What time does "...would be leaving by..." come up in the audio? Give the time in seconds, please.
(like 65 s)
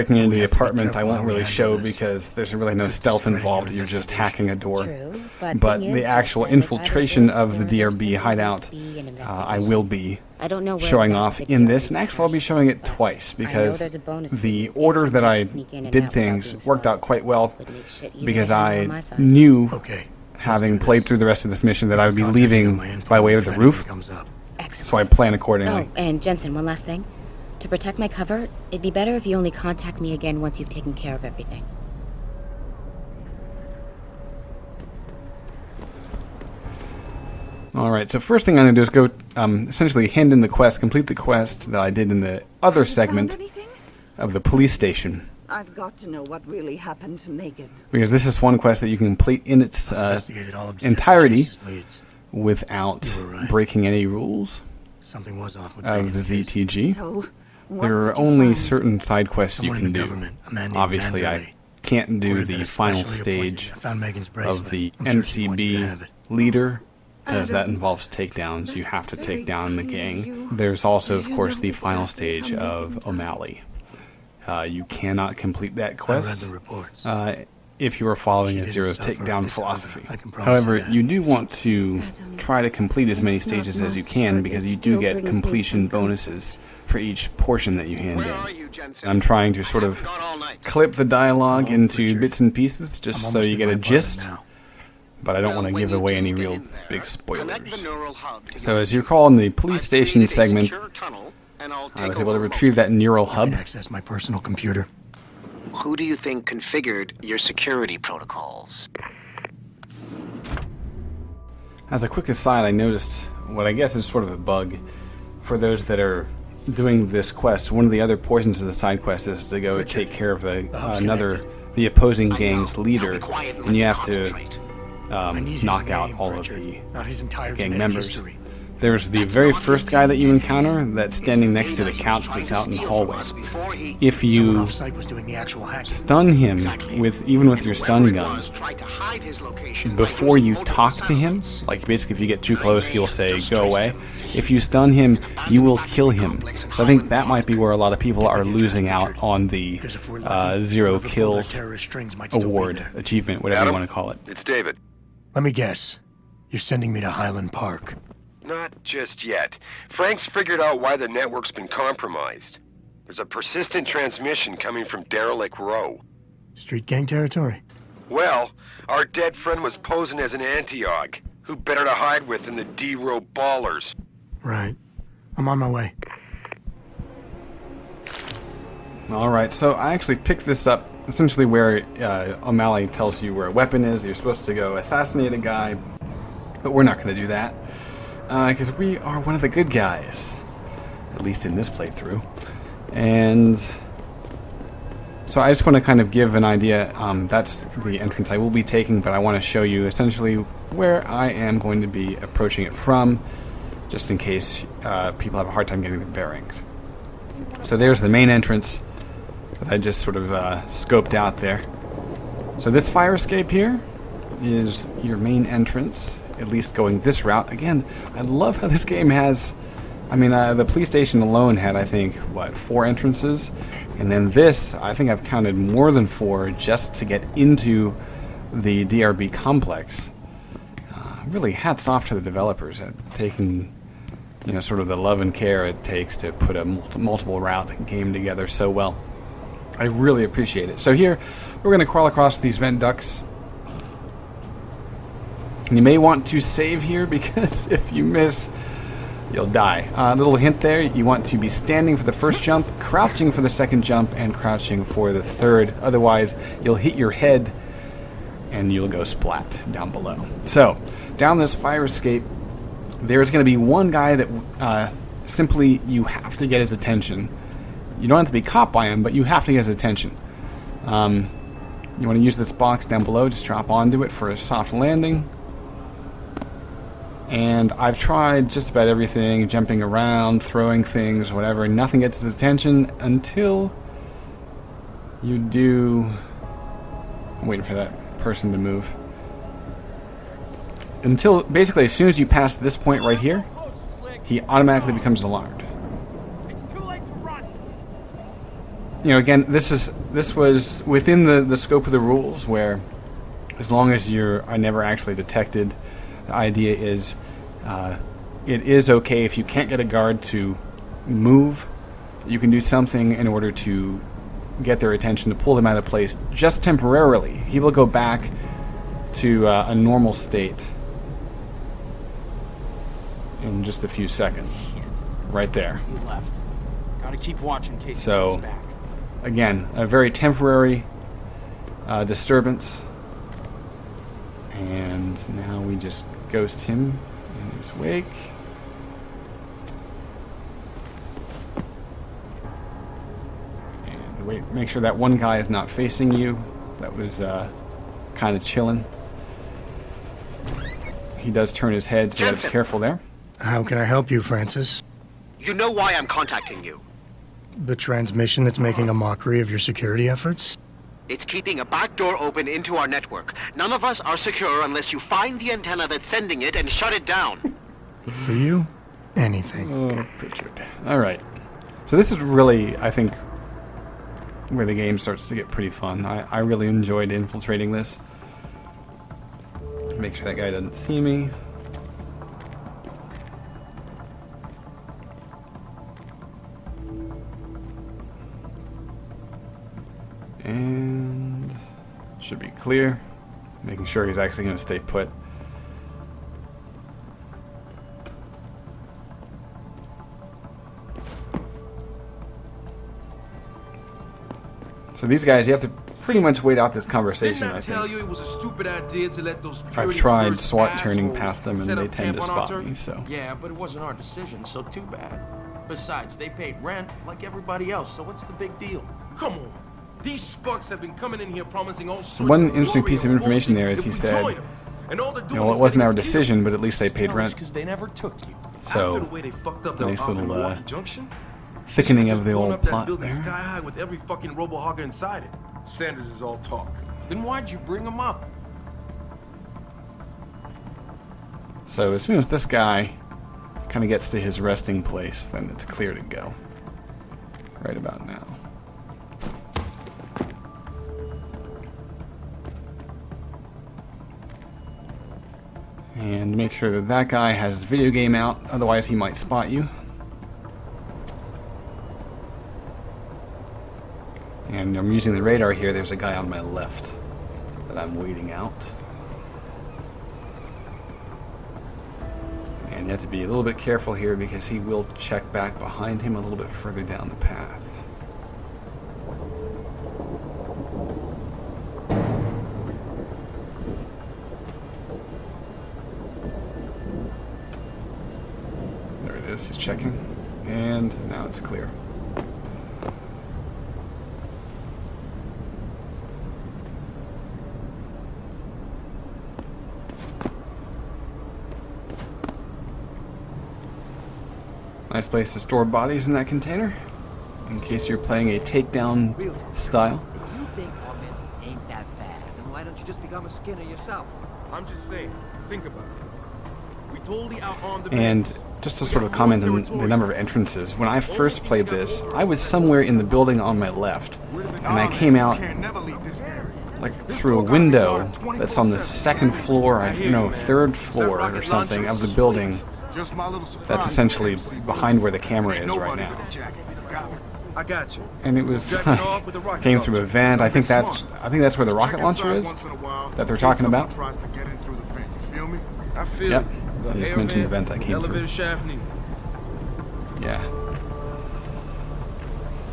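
22 s.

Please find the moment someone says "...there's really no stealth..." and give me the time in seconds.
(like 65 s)
2 s.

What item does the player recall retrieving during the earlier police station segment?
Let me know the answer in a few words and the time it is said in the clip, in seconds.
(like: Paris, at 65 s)
neural hub, at 102 s.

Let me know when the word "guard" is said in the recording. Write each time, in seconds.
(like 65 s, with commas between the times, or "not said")
309 s.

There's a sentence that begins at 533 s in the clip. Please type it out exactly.
That's essentially behind where the camera is right now.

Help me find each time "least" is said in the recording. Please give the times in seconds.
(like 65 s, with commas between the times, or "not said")
191 s, 216 s, 426 s.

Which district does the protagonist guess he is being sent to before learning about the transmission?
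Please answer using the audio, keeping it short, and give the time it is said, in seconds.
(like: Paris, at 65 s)
Highland Park, at 157 s.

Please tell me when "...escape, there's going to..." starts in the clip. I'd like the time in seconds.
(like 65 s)
261 s.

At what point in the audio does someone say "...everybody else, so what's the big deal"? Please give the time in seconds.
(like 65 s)
417 s.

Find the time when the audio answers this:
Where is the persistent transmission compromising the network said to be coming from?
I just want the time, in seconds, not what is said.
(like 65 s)
165 s.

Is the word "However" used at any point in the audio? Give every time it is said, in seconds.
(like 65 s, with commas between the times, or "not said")
80 s.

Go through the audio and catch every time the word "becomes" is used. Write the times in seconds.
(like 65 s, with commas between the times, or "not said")
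294 s, 513 s.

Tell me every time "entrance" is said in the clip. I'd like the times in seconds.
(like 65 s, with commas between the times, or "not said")
198 s, 208 s, 215 s, 222 s, 520 s.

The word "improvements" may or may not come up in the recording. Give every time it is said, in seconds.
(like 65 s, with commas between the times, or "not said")
not said.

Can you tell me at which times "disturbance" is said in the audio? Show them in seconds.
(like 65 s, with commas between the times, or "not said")
332 s.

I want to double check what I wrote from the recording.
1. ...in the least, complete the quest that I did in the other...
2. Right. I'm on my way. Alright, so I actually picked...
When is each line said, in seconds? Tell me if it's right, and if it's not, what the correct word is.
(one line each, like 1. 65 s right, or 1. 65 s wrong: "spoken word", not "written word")
1. 40 s wrong: "quest", not "least"
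2. 174 s right.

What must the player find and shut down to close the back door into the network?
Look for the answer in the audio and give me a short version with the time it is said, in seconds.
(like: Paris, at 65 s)
the antenna, at 365 s.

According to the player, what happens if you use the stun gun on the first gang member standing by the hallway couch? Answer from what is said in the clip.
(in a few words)
you will kill him.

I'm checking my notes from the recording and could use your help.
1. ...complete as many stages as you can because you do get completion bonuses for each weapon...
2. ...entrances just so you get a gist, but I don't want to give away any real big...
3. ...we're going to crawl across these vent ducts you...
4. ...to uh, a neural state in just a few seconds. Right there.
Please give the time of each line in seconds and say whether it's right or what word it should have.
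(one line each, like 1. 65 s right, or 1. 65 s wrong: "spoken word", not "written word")
1. 82 s wrong: "portion", not "weapon"
2. 92 s wrong: "pieces", not "entrances"
3. 241 s right
4. 319 s wrong: "normal", not "neural".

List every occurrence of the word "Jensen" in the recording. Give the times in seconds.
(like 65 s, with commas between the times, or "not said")
26 s, 352 s.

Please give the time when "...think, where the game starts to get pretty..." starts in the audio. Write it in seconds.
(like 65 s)
372 s.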